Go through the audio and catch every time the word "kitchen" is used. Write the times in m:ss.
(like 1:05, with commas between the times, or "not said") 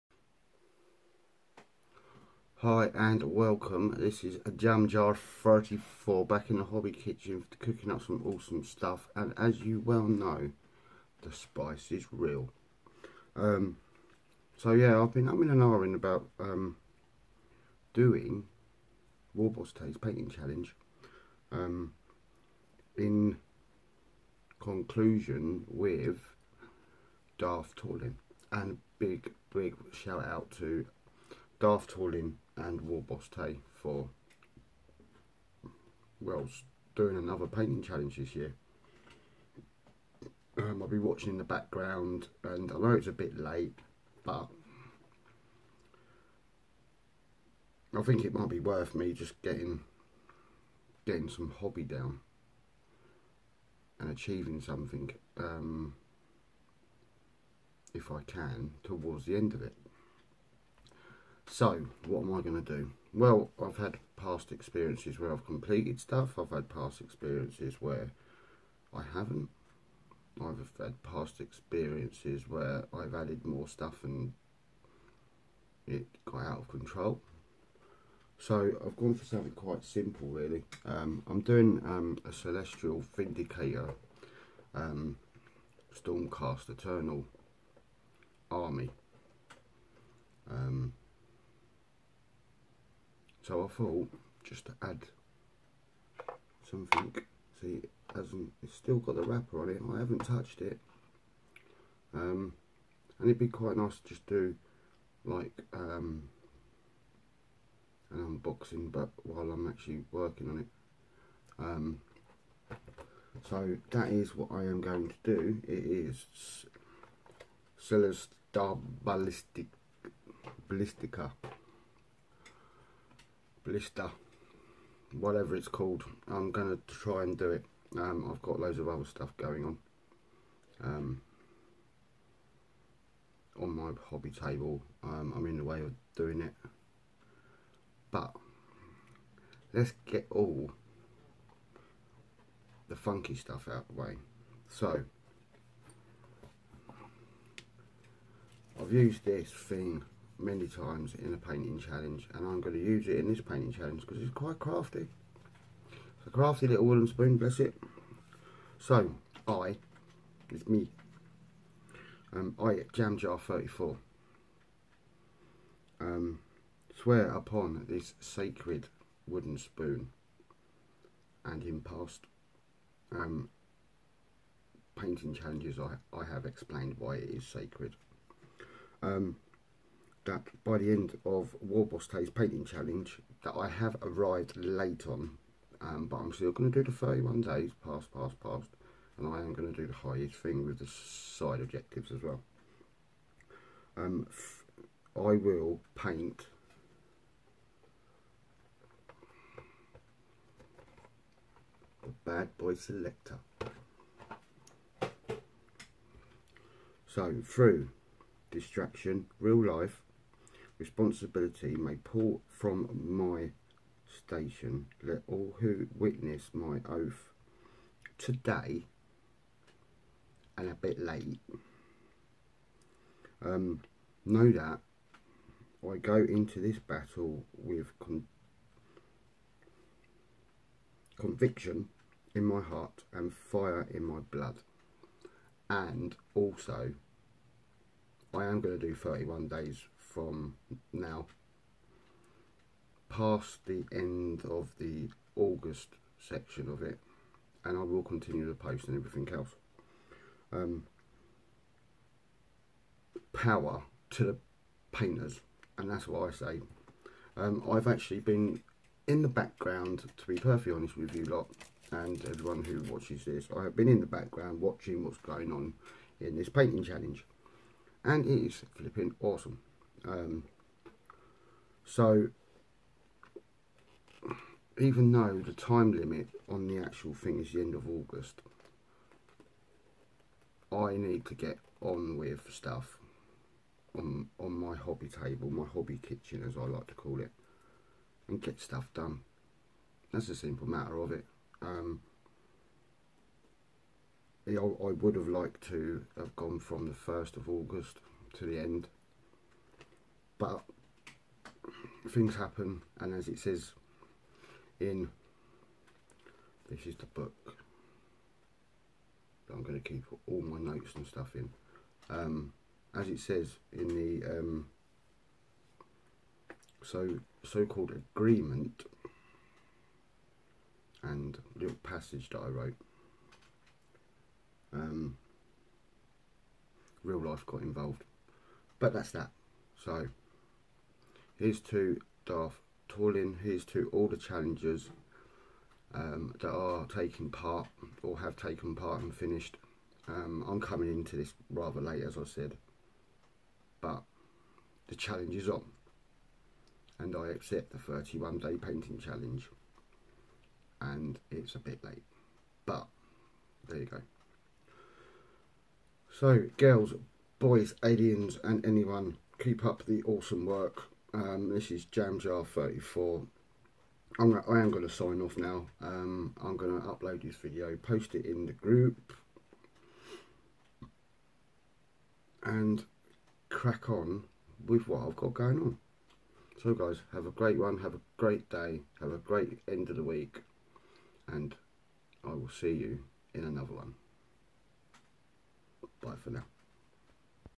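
0:06, 4:46.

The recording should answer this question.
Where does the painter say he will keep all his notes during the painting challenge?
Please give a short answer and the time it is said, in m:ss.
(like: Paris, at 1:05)
the book, at 5:06.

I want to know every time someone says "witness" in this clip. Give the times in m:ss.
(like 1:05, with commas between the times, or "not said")
3:35.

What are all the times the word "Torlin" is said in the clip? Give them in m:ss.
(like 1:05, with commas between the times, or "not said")
0:27, 0:31, 5:32.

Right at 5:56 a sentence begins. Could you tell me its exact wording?
So girls, boys, aliens and anyone, keep up the awesome work um, this is Jam Jar 34.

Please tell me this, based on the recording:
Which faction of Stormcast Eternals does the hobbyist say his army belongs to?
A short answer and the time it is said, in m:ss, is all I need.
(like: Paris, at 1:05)
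Celestial Vindicator, at 1:22.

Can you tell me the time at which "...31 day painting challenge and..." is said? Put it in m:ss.
5:47.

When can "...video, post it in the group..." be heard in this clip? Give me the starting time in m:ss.
6:07.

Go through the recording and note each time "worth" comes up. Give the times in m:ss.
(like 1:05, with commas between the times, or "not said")
0:48.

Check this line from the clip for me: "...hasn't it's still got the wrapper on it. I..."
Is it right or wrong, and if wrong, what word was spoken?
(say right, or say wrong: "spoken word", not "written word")
right.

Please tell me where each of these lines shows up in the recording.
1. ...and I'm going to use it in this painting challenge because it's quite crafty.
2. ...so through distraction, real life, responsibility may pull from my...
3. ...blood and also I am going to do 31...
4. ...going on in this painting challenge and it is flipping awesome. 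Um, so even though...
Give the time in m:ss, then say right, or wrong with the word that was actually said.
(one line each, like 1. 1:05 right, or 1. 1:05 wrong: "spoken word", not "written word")
1. 2:32 right
2. 3:27 right
3. 3:54 right
4. 4:25 right.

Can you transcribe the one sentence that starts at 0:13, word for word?
Um, so yeah, I've been up in an iron about um, doing Warboss Taste Painting Challenge.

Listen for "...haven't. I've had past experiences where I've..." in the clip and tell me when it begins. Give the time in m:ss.
1:09.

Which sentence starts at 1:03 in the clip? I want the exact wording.
Well, I've had past experiences where I've completed stuff.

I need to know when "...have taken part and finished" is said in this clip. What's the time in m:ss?
5:38.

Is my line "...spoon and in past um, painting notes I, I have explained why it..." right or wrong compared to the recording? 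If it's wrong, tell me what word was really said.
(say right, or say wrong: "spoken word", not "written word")
wrong: "challenges", not "notes".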